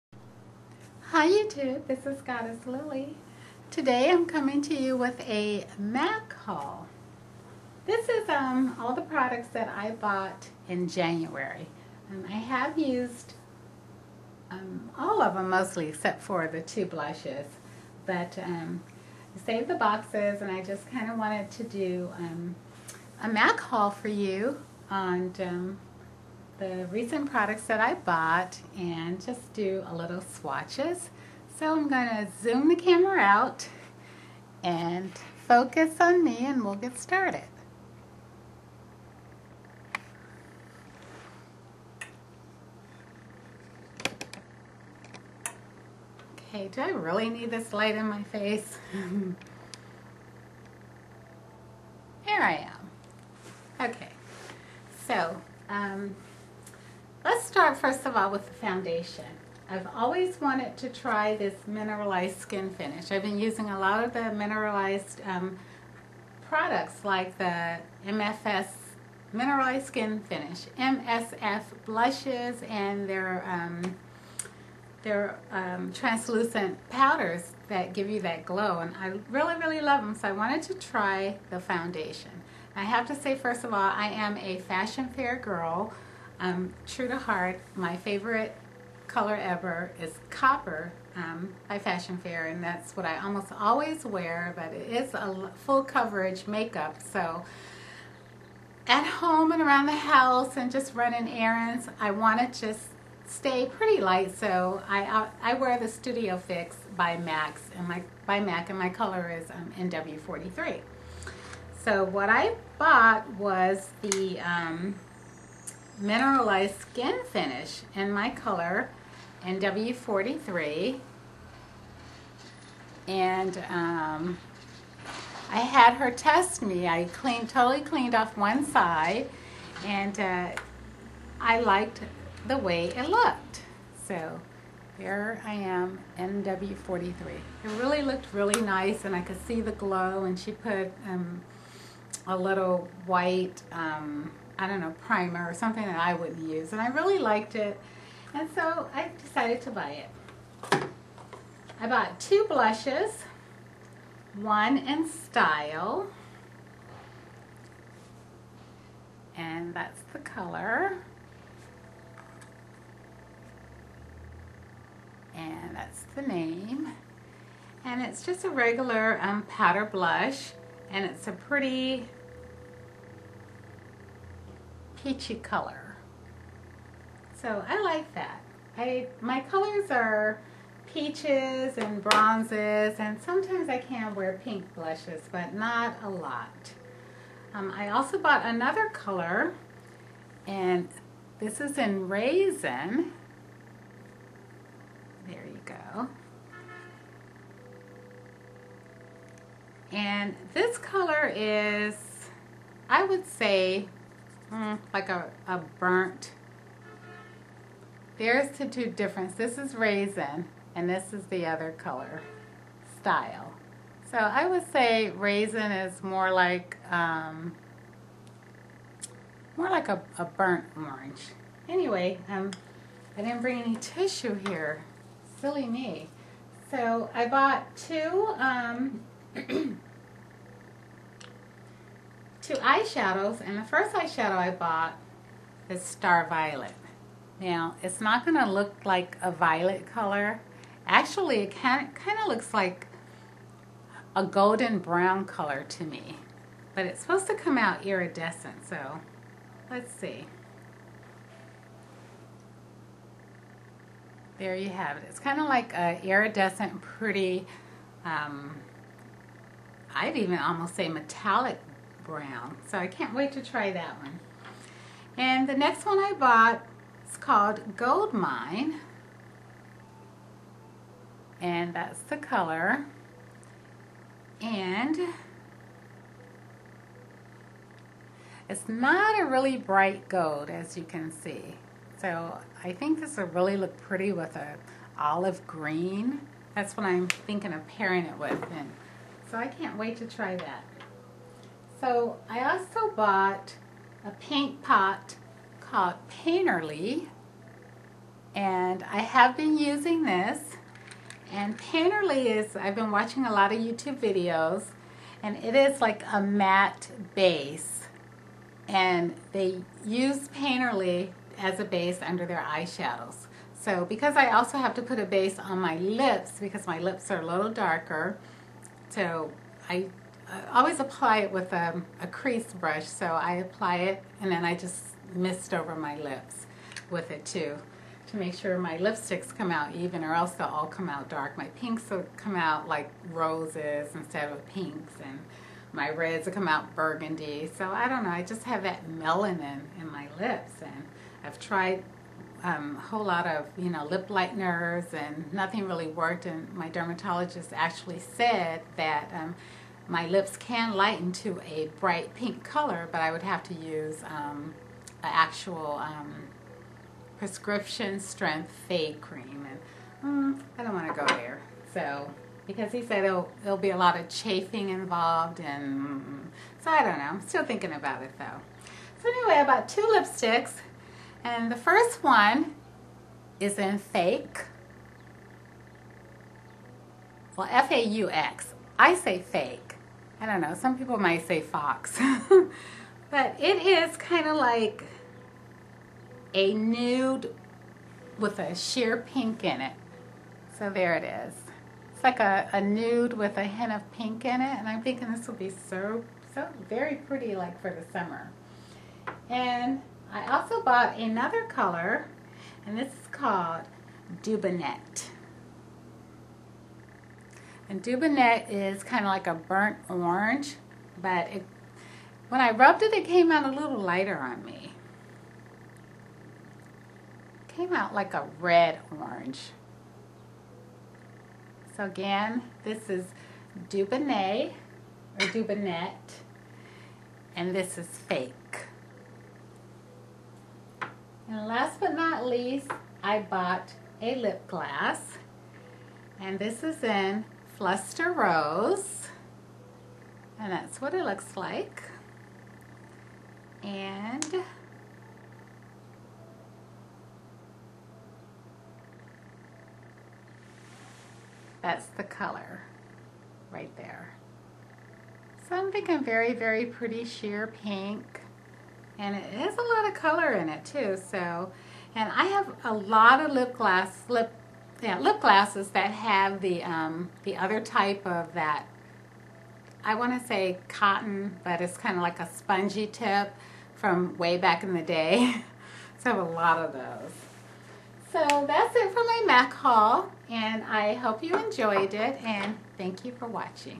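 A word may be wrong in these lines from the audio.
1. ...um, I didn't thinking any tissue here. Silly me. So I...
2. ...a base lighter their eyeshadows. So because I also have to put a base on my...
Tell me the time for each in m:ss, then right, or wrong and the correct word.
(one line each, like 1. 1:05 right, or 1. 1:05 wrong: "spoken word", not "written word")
1. 3:42 wrong: "bring", not "thinking"
2. 5:11 wrong: "under", not "lighter".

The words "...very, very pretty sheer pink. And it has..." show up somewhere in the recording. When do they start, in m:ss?
7:36.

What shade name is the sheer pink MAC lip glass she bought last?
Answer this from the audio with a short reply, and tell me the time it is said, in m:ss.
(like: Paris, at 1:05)
Luster Rose, at 7:17.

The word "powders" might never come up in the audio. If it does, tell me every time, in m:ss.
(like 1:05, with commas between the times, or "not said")
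1:16, 2:49.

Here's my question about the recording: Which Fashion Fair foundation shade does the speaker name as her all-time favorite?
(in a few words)
Copper.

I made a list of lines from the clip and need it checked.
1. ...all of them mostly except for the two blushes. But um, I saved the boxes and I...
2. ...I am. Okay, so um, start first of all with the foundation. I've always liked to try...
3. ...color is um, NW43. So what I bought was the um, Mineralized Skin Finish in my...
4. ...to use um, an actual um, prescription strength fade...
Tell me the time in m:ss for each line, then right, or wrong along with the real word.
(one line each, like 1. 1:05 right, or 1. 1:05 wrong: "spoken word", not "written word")
1. 0:14 right
2. 0:52 wrong: "wanted", not "liked"
3. 1:48 right
4. 5:53 right.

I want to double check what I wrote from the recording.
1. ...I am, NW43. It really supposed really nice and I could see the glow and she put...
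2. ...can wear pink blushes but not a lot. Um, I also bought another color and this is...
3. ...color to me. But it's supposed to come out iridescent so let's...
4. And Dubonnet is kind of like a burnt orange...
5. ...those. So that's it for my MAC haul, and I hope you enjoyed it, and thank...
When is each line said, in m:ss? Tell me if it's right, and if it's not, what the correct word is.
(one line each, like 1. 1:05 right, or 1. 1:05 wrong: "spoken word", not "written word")
1. 2:15 wrong: "looked", not "supposed"
2. 3:03 right
3. 4:05 right
4. 6:47 right
5. 7:56 right.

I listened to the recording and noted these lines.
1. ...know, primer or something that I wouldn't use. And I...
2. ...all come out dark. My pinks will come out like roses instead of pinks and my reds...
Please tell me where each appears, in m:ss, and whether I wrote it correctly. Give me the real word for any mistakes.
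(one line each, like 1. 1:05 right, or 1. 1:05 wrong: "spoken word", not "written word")
1. 2:24 right
2. 5:30 right.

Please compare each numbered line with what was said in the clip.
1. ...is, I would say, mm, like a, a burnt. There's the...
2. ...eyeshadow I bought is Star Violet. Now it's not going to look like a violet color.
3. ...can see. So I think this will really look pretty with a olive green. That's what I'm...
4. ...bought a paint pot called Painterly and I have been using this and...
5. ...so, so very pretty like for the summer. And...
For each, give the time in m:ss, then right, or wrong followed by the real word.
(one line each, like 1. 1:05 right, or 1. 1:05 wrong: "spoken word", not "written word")
1. 3:21 right
2. 3:53 right
3. 4:40 right
4. 4:52 right
5. 6:35 right.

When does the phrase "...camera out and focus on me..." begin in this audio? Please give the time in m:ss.
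0:32.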